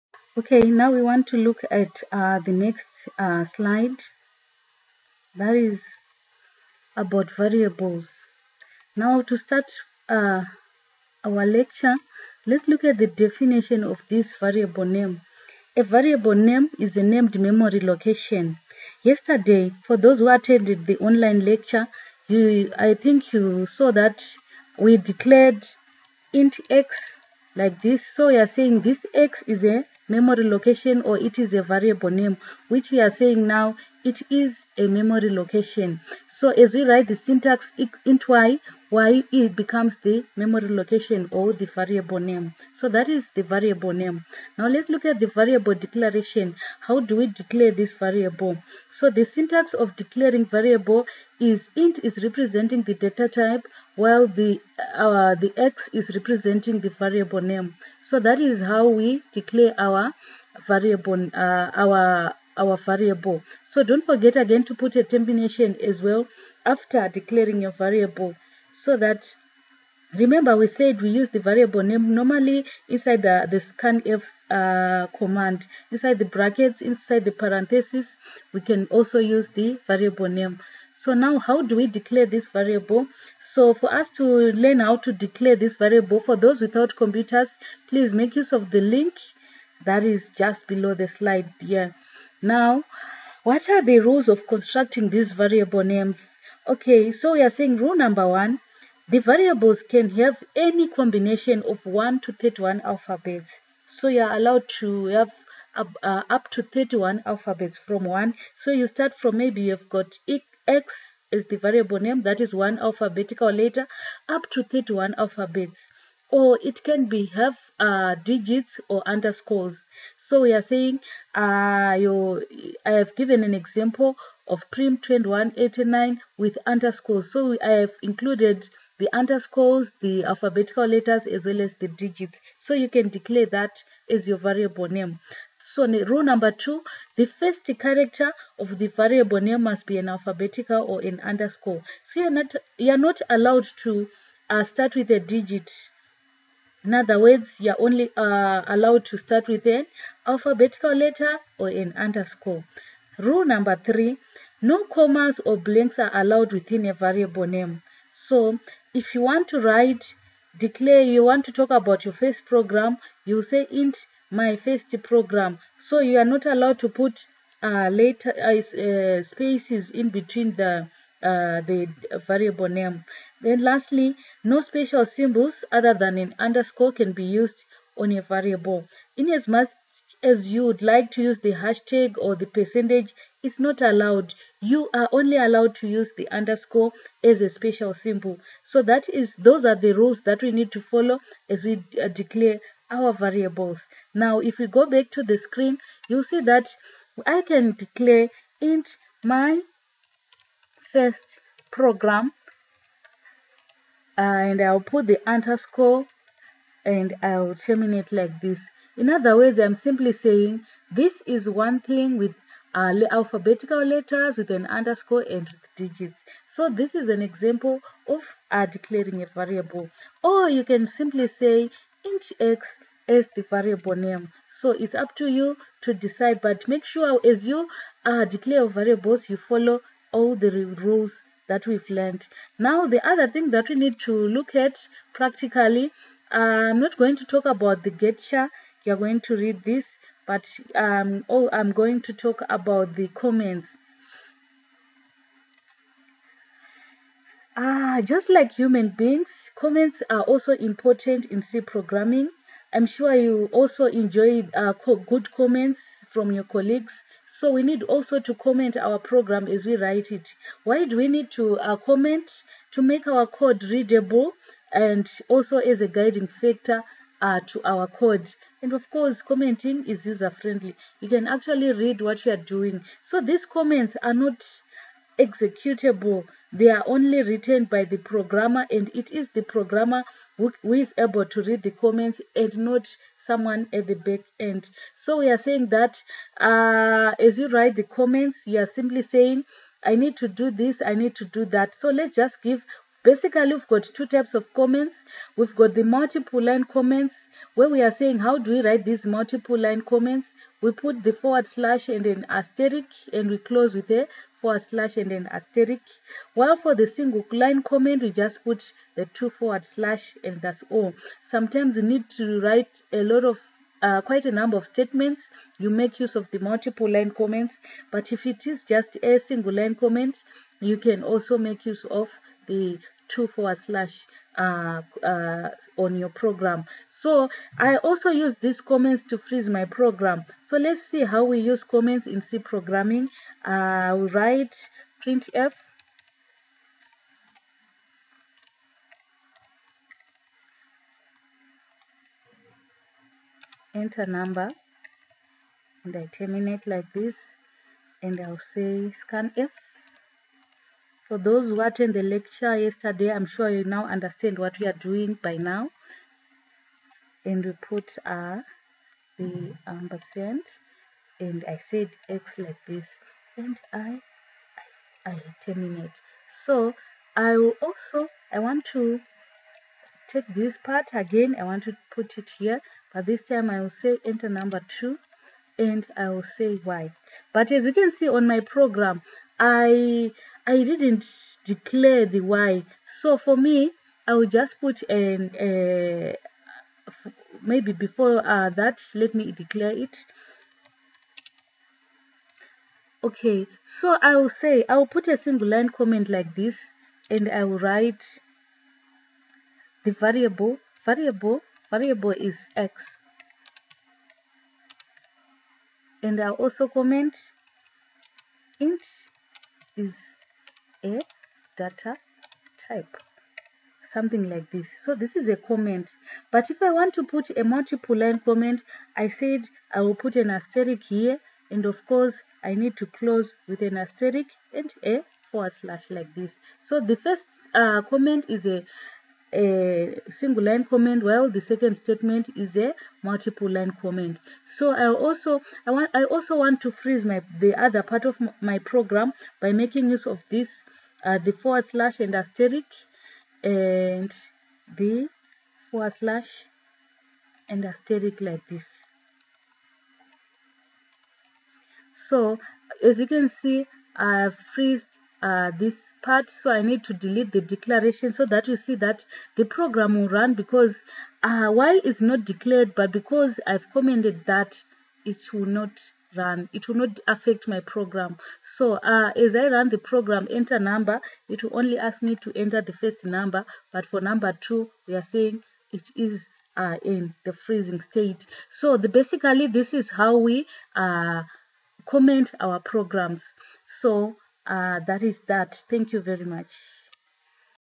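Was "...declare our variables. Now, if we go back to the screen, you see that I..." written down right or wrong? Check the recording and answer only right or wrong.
right.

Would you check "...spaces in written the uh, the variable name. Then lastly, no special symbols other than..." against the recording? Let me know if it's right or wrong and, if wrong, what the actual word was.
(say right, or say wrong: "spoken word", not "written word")
wrong: "between", not "written".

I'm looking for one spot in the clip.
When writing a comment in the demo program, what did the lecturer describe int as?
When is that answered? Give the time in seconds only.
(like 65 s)
408 s.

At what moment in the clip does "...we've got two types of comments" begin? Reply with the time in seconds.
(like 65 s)
293 s.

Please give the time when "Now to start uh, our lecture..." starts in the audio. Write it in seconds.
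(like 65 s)
8 s.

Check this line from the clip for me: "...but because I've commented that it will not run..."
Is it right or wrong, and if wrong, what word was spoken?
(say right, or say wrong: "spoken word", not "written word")
right.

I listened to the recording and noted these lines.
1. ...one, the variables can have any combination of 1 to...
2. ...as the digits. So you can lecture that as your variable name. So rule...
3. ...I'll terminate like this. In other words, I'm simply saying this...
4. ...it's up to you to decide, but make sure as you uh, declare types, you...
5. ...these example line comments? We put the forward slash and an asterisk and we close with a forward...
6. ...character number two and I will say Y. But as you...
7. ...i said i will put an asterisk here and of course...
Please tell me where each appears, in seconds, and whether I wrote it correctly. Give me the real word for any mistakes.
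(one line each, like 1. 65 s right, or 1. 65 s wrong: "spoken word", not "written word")
1. 98 s right
2. 131 s wrong: "declare", not "lecture"
3. 207 s right
4. 224 s wrong: "variables", not "types"
5. 298 s wrong: "multiple", not "example"
6. 374 s wrong: "enter", not "character"
7. 418 s right.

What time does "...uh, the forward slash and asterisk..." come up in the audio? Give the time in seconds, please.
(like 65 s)
441 s.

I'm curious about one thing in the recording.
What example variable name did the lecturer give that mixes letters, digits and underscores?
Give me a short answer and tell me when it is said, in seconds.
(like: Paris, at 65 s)
prim 2189, at 124 s.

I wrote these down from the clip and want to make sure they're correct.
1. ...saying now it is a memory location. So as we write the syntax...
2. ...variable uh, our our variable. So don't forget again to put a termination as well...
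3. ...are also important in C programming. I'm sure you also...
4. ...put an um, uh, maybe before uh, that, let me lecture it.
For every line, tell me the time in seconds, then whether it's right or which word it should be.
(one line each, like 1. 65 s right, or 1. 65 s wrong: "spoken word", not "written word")
1. 33 s right
2. 60 s right
3. 250 s right
4. 384 s wrong: "declare", not "lecture".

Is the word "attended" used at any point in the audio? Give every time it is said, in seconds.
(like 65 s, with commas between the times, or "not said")
20 s, 351 s.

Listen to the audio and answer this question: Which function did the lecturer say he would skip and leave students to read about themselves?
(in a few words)
getch.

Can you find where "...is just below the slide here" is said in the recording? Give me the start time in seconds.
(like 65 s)
90 s.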